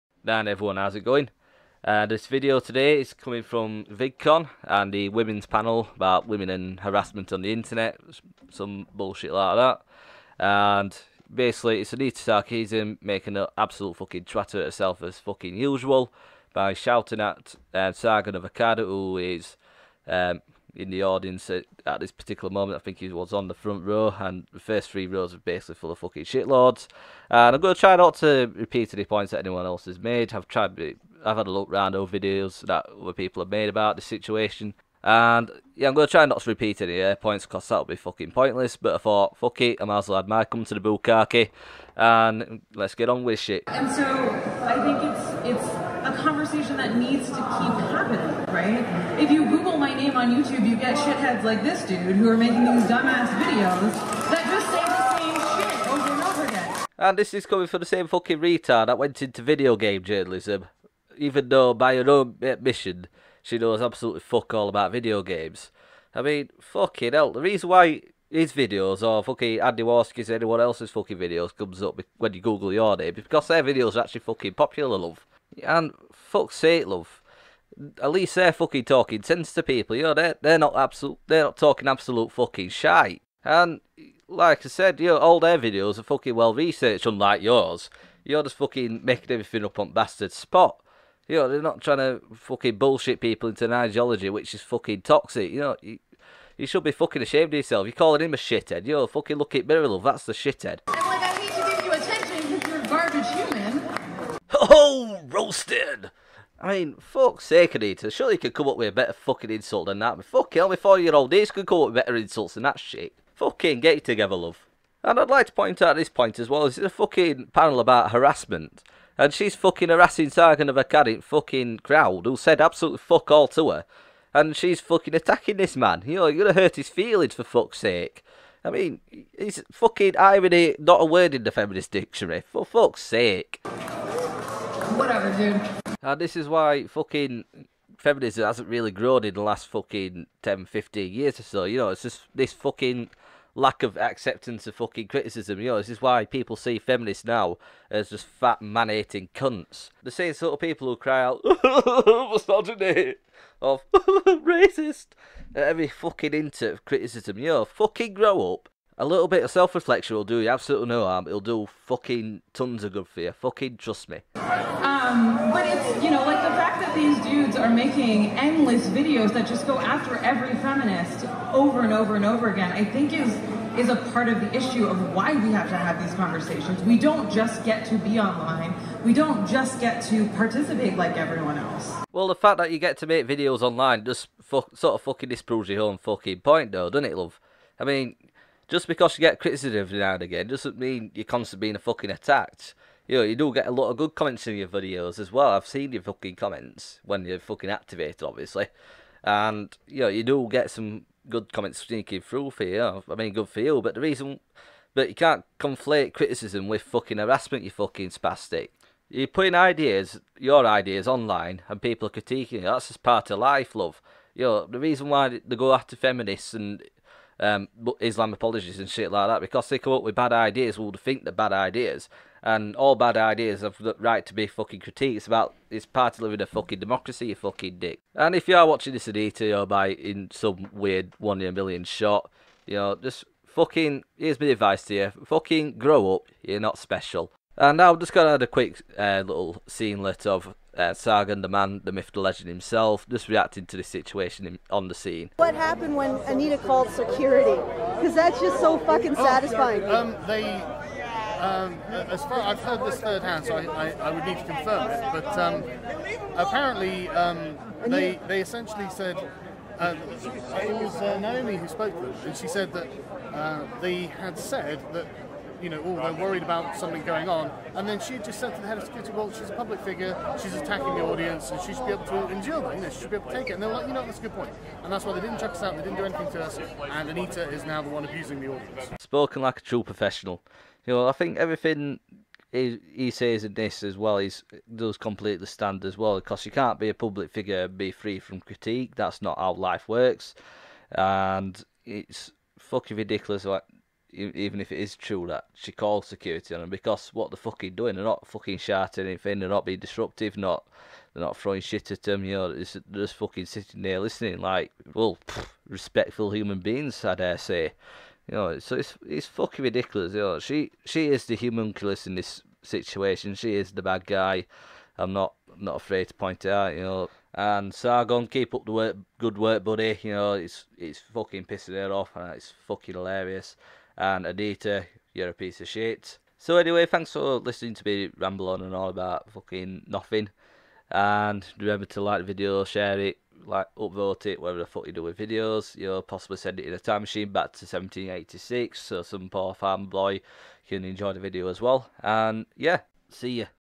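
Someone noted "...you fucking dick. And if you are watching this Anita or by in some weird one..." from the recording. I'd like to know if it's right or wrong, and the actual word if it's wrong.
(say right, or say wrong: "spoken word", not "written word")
right.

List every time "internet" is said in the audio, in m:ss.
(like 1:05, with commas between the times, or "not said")
0:07.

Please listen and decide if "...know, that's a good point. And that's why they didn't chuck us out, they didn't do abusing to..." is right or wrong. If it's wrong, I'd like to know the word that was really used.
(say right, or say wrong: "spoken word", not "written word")
wrong: "anything", not "abusing".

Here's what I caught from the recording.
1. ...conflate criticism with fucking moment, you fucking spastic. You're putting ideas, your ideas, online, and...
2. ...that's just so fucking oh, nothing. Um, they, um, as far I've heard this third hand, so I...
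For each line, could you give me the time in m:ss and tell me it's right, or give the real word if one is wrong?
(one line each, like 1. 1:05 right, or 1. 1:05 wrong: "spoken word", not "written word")
1. 3:25 wrong: "harassment", not "moment"
2. 4:08 wrong: "satisfying", not "nothing".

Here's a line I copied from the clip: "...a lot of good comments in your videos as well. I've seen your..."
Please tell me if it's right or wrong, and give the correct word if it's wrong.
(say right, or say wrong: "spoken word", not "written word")
right.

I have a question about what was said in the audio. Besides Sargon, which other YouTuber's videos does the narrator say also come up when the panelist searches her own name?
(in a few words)
Andy Warski.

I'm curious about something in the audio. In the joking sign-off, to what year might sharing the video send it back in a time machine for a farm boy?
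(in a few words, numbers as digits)
1786.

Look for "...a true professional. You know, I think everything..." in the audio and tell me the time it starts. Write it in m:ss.
4:39.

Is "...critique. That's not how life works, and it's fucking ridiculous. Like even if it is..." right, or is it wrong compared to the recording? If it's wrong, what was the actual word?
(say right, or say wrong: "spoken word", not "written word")
right.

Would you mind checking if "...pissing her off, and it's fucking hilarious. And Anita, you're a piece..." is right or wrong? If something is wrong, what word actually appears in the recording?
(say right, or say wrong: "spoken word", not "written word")
right.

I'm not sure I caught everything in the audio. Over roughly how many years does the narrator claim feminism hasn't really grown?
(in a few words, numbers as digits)
10, 15 years.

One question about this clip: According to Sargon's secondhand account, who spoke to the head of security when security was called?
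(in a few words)
Naomi.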